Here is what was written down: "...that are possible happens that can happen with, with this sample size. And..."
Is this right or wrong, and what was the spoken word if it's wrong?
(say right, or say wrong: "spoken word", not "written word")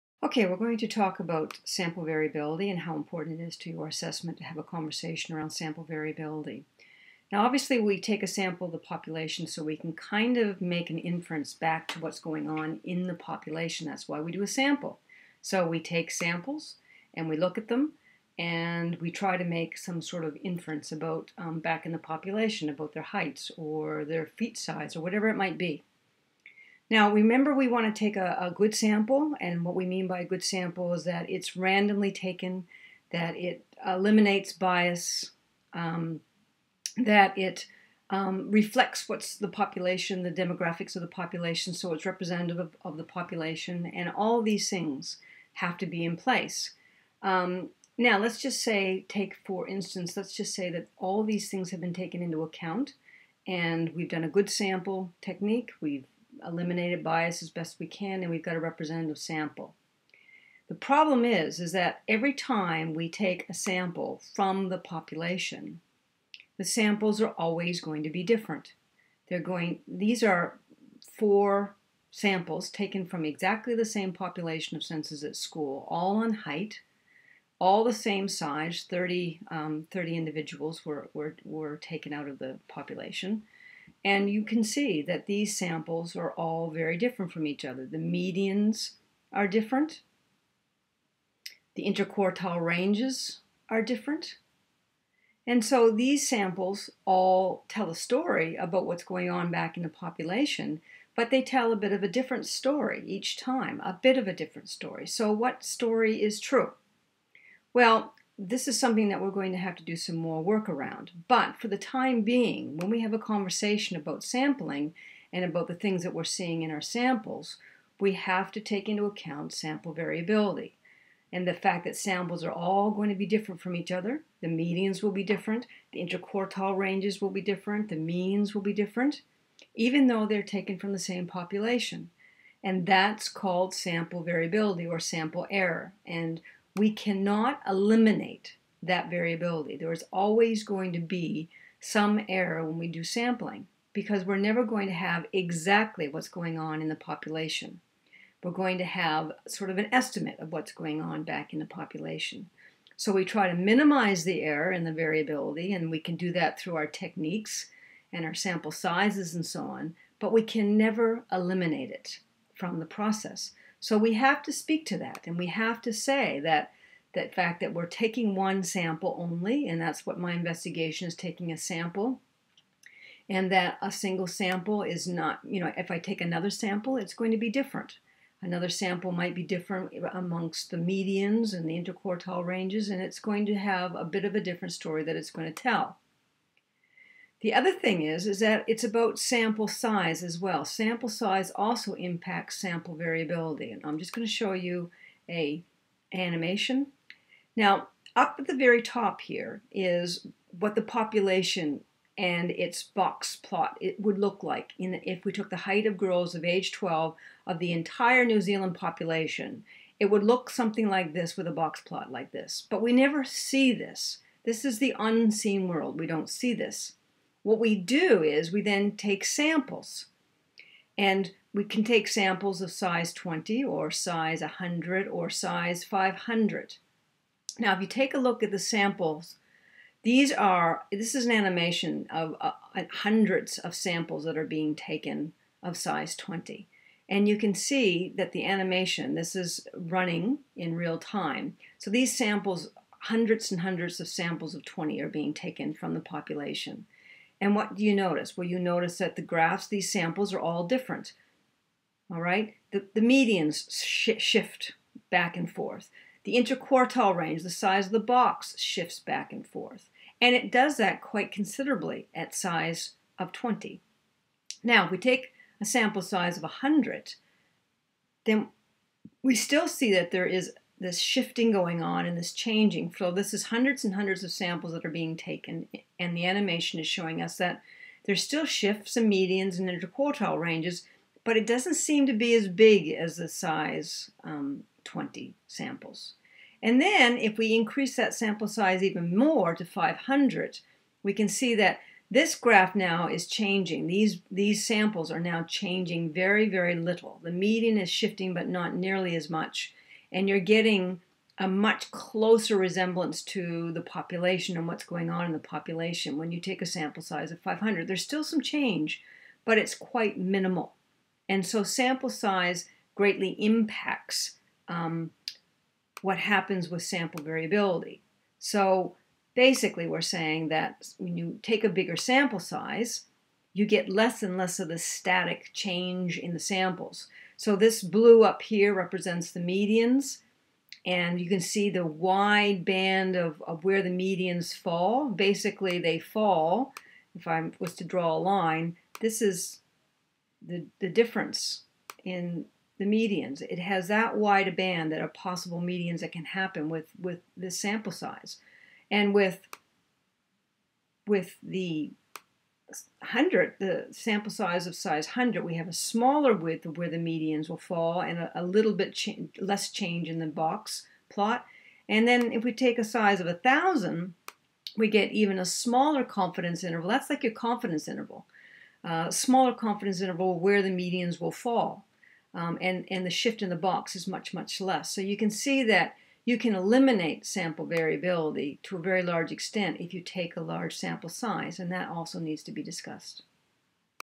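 wrong: "medians", not "happens".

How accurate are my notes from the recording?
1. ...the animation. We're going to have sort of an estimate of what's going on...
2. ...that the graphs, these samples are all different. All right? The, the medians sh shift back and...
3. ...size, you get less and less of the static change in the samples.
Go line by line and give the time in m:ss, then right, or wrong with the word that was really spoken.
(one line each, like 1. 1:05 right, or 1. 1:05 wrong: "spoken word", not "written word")
1. 2:26 wrong: "population", not "animation"
2. 4:08 right
3. 5:22 right.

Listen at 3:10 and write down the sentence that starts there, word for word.
Sample size also impacts sample variability.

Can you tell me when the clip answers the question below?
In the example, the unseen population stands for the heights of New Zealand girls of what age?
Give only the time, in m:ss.
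3:26.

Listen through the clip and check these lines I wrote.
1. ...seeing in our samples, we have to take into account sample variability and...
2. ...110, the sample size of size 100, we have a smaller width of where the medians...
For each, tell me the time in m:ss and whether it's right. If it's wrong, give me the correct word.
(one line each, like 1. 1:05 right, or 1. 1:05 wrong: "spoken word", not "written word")
1. 1:56 right
2. 5:52 wrong: "100", not "110".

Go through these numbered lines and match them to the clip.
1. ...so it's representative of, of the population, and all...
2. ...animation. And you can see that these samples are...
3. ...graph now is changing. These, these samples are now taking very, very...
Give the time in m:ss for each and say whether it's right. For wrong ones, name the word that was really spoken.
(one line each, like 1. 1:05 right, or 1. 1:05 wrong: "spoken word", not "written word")
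1. 0:41 right
2. 1:22 wrong: "population", not "animation"
3. 4:52 wrong: "changing", not "taking".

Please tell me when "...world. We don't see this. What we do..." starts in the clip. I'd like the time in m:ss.
3:35.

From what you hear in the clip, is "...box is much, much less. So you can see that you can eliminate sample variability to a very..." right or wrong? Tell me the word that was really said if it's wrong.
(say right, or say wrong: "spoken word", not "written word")
right.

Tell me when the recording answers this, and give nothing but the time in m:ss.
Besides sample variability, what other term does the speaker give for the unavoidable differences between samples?
2:14.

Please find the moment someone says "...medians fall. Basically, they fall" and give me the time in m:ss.
5:33.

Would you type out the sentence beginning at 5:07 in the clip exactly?
There's still some change, but it's quite minimal.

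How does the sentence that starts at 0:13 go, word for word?
That's why we do a sample.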